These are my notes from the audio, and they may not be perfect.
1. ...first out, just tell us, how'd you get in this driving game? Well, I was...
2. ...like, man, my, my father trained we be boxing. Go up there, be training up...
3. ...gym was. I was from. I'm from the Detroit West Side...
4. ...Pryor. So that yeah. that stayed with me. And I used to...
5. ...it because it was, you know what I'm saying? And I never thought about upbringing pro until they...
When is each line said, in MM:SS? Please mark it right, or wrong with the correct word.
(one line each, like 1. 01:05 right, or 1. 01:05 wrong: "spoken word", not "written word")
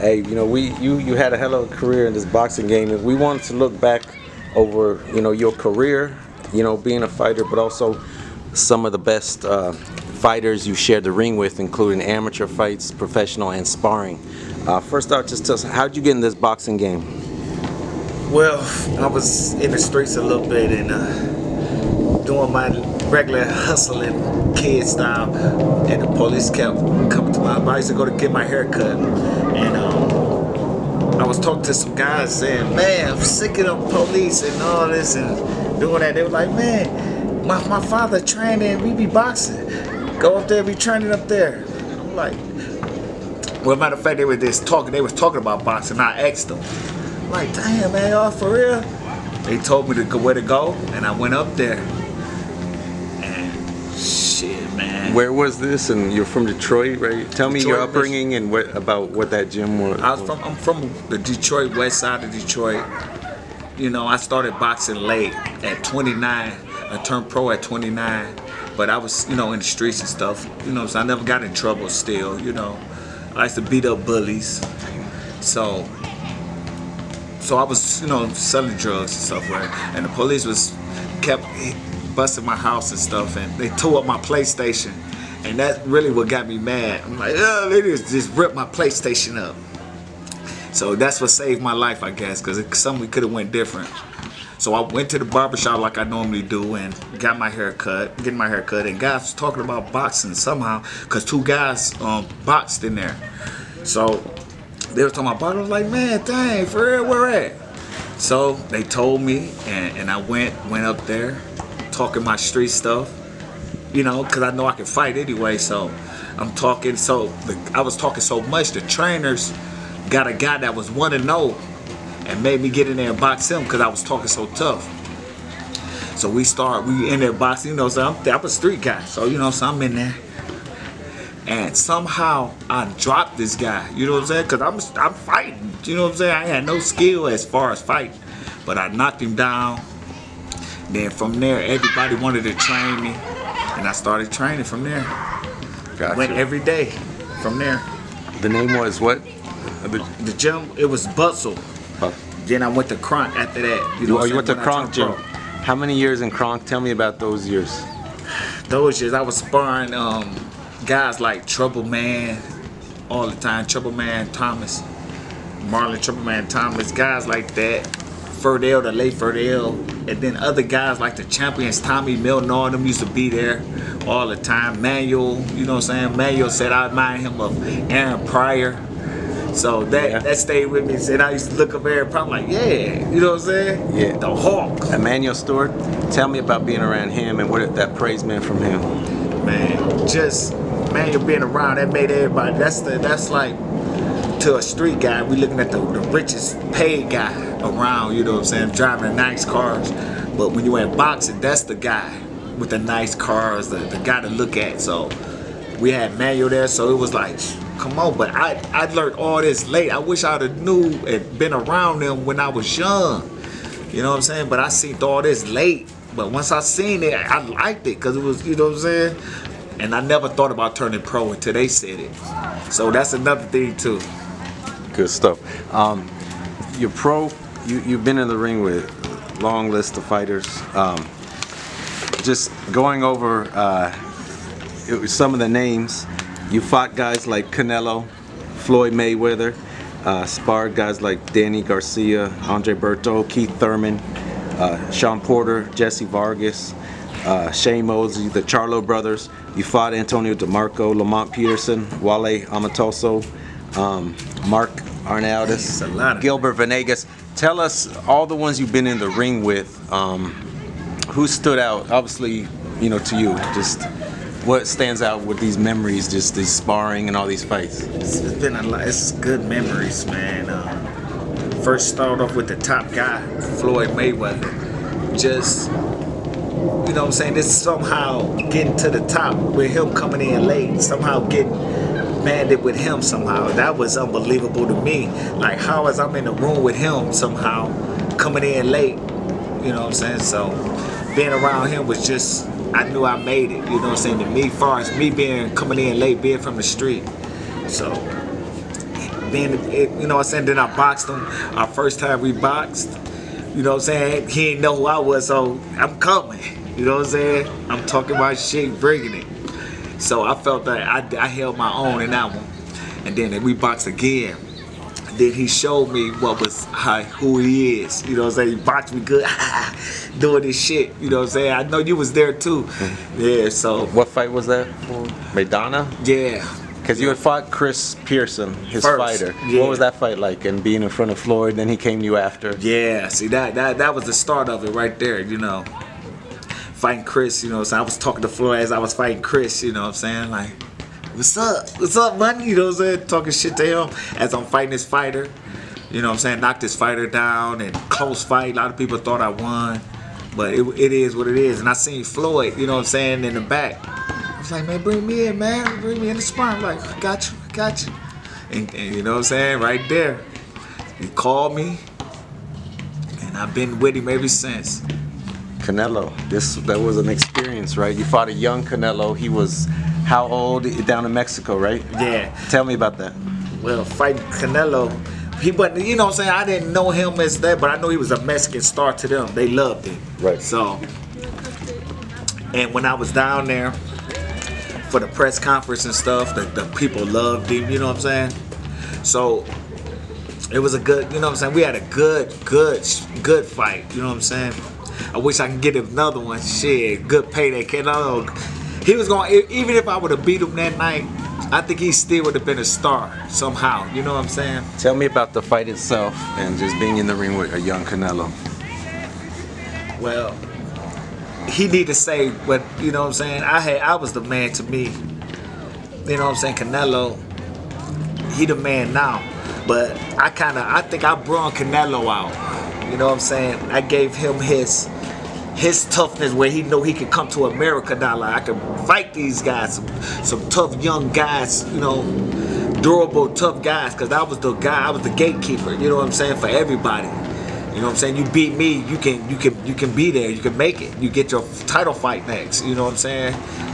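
1. 00:14 wrong: "boxing", not "driving"
2. 00:36 right
3. 00:59 right
4. 02:58 right
5. 03:37 wrong: "turning", not "upbringing".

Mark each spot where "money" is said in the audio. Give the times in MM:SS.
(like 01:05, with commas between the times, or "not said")
05:42.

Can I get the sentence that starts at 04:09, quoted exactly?
You fought Antonio DeMarco, Lamont Peterson, Wale Omotoso, um, Mark Arnaoutis, Gilbert Venegas.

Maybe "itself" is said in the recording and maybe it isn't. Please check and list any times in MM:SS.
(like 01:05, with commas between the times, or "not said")
06:45.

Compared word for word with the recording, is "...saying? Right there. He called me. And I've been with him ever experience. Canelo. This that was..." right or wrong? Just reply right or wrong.
wrong.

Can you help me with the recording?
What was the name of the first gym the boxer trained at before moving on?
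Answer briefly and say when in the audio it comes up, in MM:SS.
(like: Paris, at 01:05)
Bustle, at 02:31.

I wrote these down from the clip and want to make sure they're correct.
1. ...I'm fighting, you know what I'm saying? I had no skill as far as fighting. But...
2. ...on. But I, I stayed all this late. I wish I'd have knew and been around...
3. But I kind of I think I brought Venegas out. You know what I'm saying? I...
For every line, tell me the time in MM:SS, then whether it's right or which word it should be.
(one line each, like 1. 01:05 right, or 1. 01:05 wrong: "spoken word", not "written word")
1. 02:14 right
2. 03:27 wrong: "learned", not "stayed"
3. 06:59 wrong: "Canelo", not "Venegas".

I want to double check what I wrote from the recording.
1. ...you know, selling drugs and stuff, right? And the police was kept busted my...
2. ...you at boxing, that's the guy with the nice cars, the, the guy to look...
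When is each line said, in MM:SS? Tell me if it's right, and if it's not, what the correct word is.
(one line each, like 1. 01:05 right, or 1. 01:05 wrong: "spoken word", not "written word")
1. 01:18 right
2. 03:20 right.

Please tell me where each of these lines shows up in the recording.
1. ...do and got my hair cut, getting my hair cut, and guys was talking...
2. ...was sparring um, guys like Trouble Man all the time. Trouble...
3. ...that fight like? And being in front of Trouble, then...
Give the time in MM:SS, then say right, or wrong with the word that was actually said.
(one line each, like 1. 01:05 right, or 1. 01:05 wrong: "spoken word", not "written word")
1. 01:36 right
2. 02:39 right
3. 05:29 wrong: "Floyd", not "Trouble".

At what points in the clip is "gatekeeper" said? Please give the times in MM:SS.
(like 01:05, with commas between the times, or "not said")
07:15.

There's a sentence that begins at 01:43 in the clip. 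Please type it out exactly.
So they were talking about boxing.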